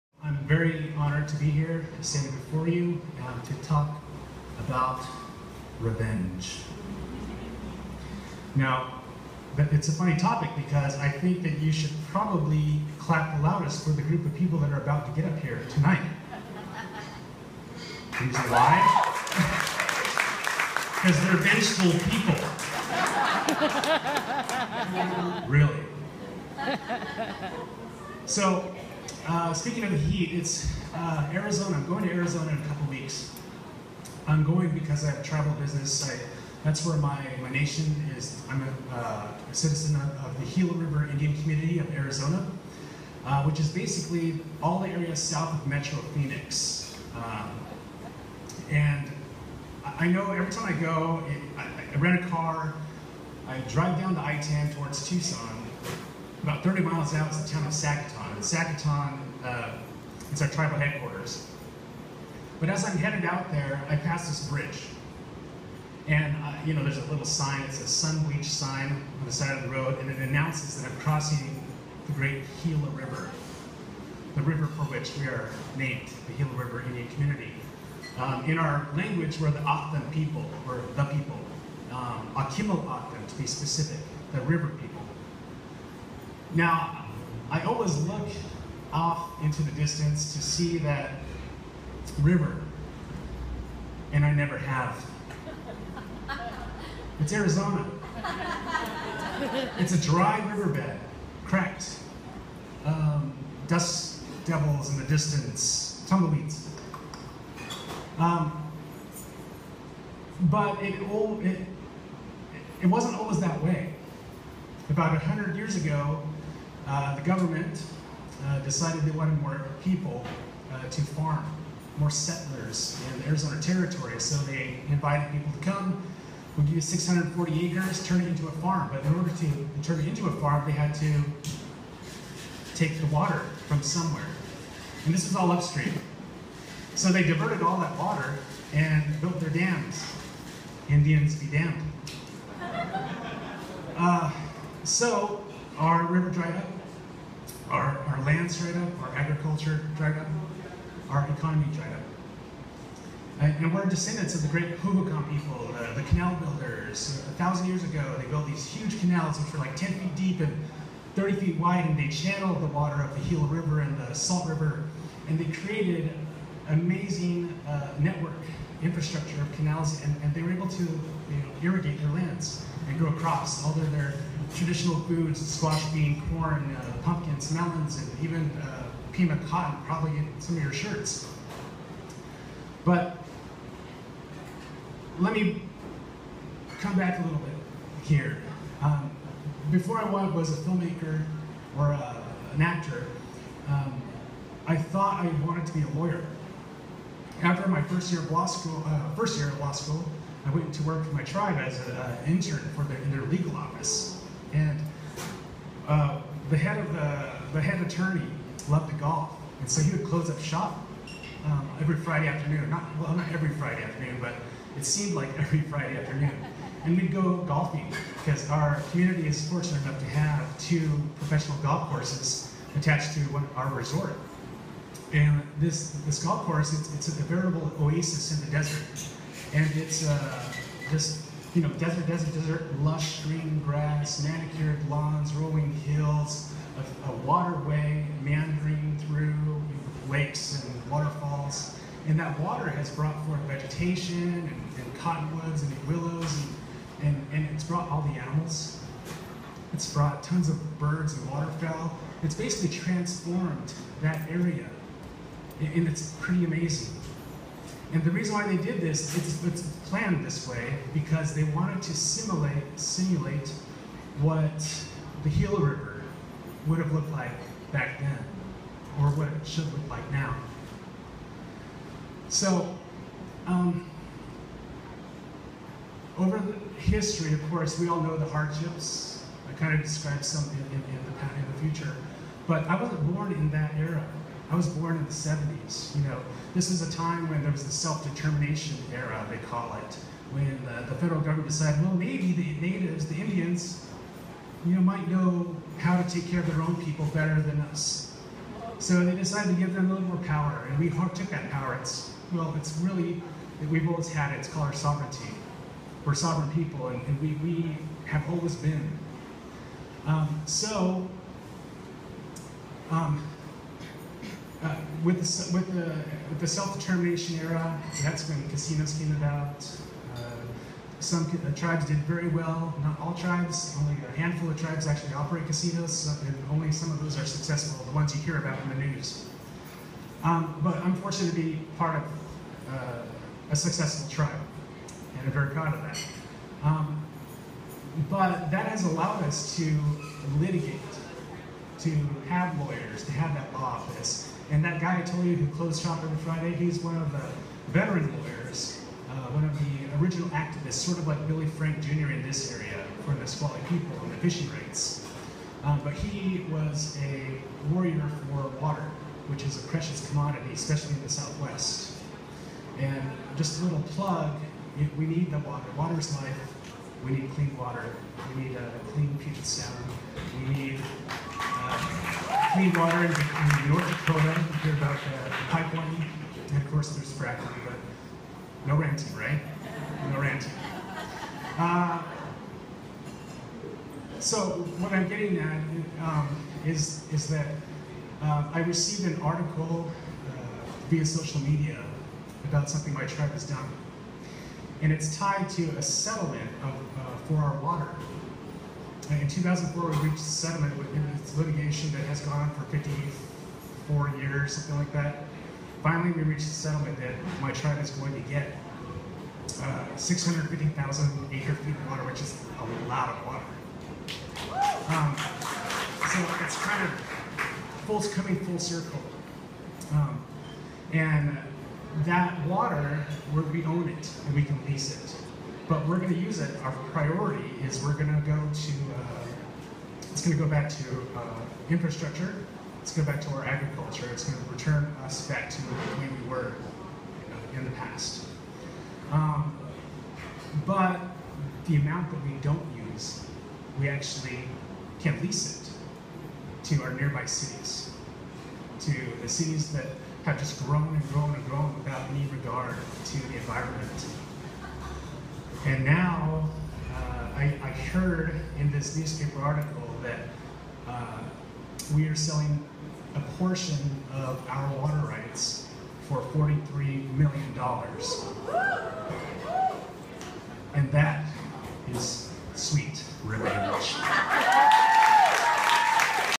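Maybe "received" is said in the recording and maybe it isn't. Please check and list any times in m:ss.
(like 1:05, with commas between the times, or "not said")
6:28.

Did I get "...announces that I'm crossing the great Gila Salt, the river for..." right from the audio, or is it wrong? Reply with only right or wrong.
wrong.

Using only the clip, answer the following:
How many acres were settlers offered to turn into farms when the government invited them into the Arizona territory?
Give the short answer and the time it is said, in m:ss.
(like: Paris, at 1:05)
640, at 2:06.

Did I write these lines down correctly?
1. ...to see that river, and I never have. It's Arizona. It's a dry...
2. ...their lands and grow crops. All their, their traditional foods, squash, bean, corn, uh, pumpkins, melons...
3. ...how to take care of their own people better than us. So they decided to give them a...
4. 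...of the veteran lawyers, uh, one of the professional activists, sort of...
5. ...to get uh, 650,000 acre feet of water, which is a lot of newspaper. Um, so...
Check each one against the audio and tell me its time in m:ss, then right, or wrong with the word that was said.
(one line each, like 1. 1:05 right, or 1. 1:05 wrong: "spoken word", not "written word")
1. 1:30 right
2. 2:52 right
3. 4:55 right
4. 5:46 wrong: "original", not "professional"
5. 6:48 wrong: "water", not "newspaper".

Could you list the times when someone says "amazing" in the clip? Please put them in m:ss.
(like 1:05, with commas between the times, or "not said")
2:46, 4:16.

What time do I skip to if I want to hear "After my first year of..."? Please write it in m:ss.
3:17.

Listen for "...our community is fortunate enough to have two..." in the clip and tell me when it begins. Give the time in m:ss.
3:38.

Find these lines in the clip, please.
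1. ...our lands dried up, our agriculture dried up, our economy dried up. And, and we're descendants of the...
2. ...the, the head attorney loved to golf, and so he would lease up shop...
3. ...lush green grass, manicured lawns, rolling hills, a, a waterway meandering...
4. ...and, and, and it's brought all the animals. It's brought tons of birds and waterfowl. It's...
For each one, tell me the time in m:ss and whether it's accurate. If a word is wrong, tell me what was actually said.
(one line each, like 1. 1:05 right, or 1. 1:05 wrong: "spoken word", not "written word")
1. 2:28 right
2. 3:26 wrong: "close", not "lease"
3. 3:52 right
4. 4:07 right.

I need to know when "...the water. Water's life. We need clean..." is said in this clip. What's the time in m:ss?
6:05.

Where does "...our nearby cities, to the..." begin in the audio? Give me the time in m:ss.
7:26.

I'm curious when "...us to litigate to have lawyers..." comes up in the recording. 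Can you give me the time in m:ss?
5:39.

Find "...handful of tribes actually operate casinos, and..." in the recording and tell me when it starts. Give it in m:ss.
5:24.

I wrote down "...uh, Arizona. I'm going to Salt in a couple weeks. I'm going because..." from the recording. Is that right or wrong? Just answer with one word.
wrong.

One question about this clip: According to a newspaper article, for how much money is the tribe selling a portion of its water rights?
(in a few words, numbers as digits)
$43 million.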